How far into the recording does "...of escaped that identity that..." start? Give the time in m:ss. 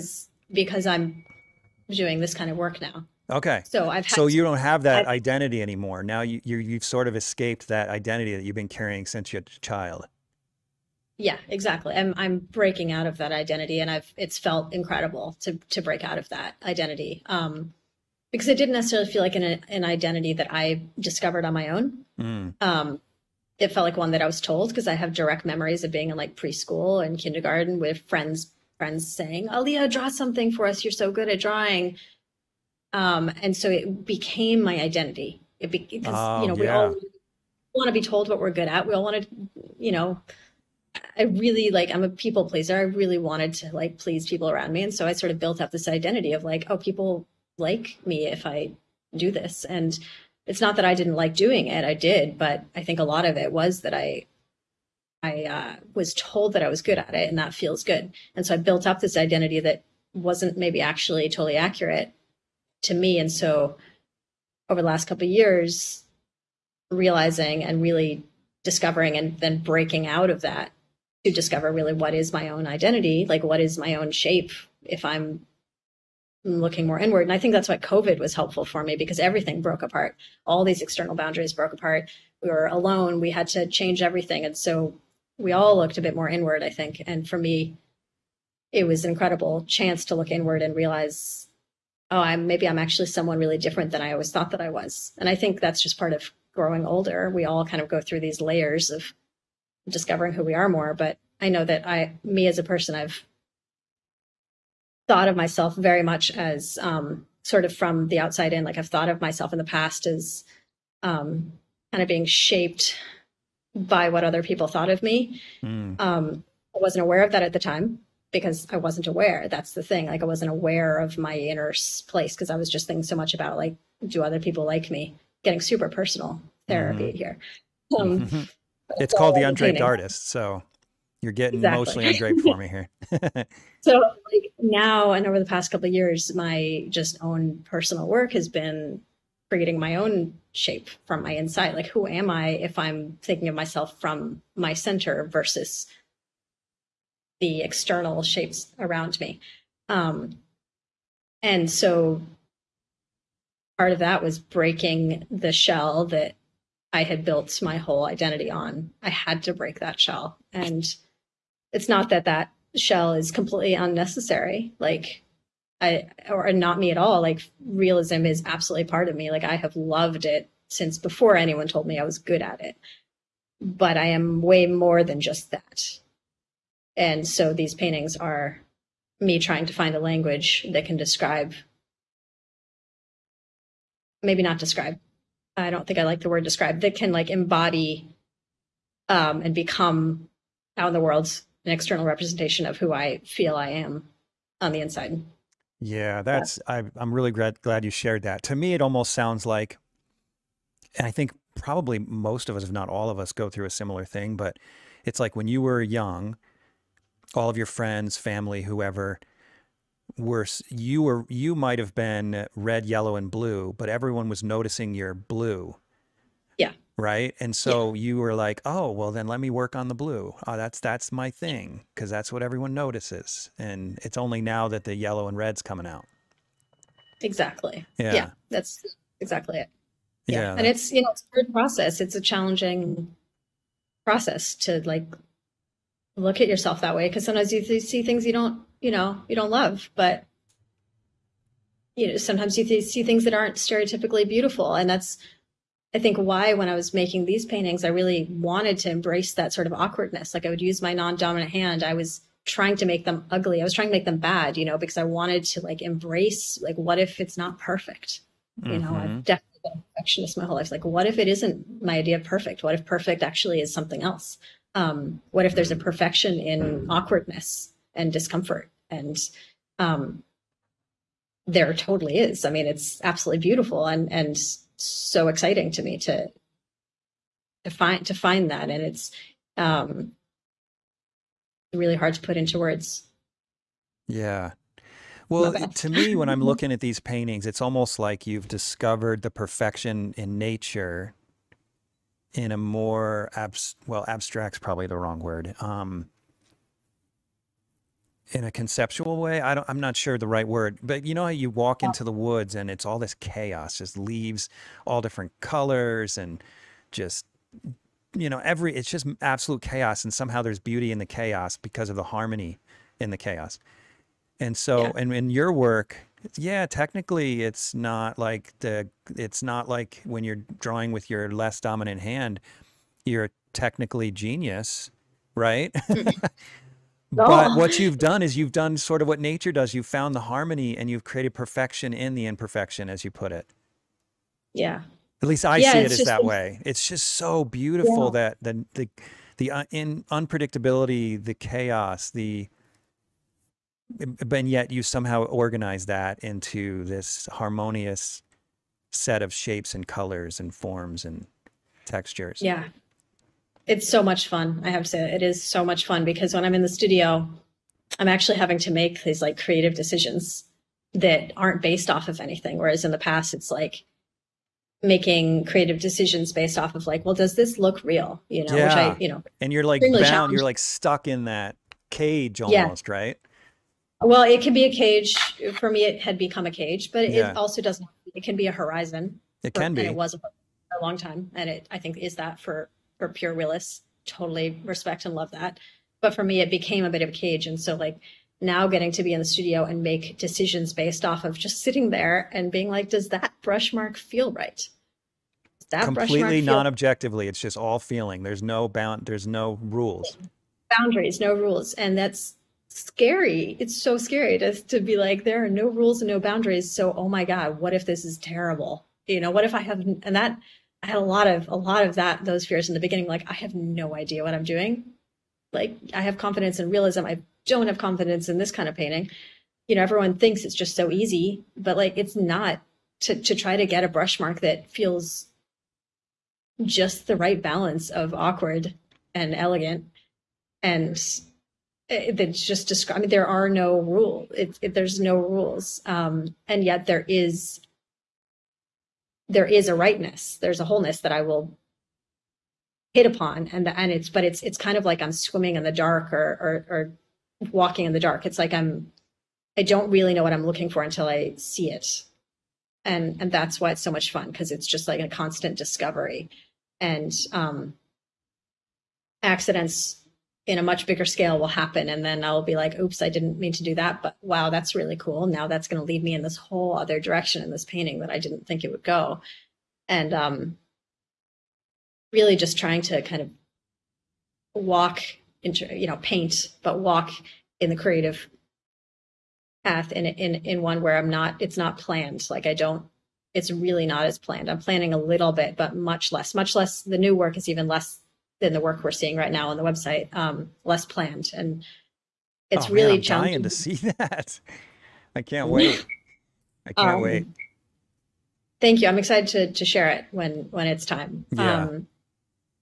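0:07.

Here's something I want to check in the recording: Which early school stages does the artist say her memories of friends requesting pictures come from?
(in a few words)
preschool and kindergarten.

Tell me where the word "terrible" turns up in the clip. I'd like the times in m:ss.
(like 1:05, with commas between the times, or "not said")
6:48.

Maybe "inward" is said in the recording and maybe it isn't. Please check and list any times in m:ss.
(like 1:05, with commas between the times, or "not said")
1:16, 1:26, 1:30.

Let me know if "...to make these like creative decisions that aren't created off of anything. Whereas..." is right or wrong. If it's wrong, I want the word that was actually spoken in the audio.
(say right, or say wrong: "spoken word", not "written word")
wrong: "based", not "created".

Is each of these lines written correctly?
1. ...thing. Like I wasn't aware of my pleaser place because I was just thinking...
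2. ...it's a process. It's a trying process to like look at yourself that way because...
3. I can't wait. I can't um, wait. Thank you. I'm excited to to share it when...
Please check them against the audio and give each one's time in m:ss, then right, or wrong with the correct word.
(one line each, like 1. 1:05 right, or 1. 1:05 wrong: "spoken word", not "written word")
1. 1:59 wrong: "inner", not "pleaser"
2. 3:51 wrong: "challenging", not "trying"
3. 8:15 right.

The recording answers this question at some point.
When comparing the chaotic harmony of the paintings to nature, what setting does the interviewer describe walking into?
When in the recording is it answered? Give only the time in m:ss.
5:02.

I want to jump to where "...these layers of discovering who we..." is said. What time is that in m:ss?
1:38.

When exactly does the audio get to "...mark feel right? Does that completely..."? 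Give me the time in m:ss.
6:33.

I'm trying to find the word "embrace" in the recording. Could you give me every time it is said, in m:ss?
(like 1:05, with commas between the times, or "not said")
4:08, 4:15.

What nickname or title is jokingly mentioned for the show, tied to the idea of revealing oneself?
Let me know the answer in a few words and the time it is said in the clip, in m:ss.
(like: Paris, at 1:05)
The Undraped Artist, at 2:09.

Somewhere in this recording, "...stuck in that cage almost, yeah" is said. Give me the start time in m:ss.
6:10.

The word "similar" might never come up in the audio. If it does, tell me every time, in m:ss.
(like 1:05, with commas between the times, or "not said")
3:23.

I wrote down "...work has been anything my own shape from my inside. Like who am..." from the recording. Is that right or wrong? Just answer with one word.
wrong.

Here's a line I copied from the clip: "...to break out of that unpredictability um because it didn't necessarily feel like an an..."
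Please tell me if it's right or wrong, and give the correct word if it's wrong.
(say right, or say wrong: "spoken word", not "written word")
wrong: "identity", not "unpredictability".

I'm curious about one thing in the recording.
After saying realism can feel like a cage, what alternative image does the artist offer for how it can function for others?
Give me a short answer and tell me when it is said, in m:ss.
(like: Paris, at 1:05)
A horizon, at 6:18.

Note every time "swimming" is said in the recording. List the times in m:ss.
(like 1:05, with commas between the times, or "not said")
7:25.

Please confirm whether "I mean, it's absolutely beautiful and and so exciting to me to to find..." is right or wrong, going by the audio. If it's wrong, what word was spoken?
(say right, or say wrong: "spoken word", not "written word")
right.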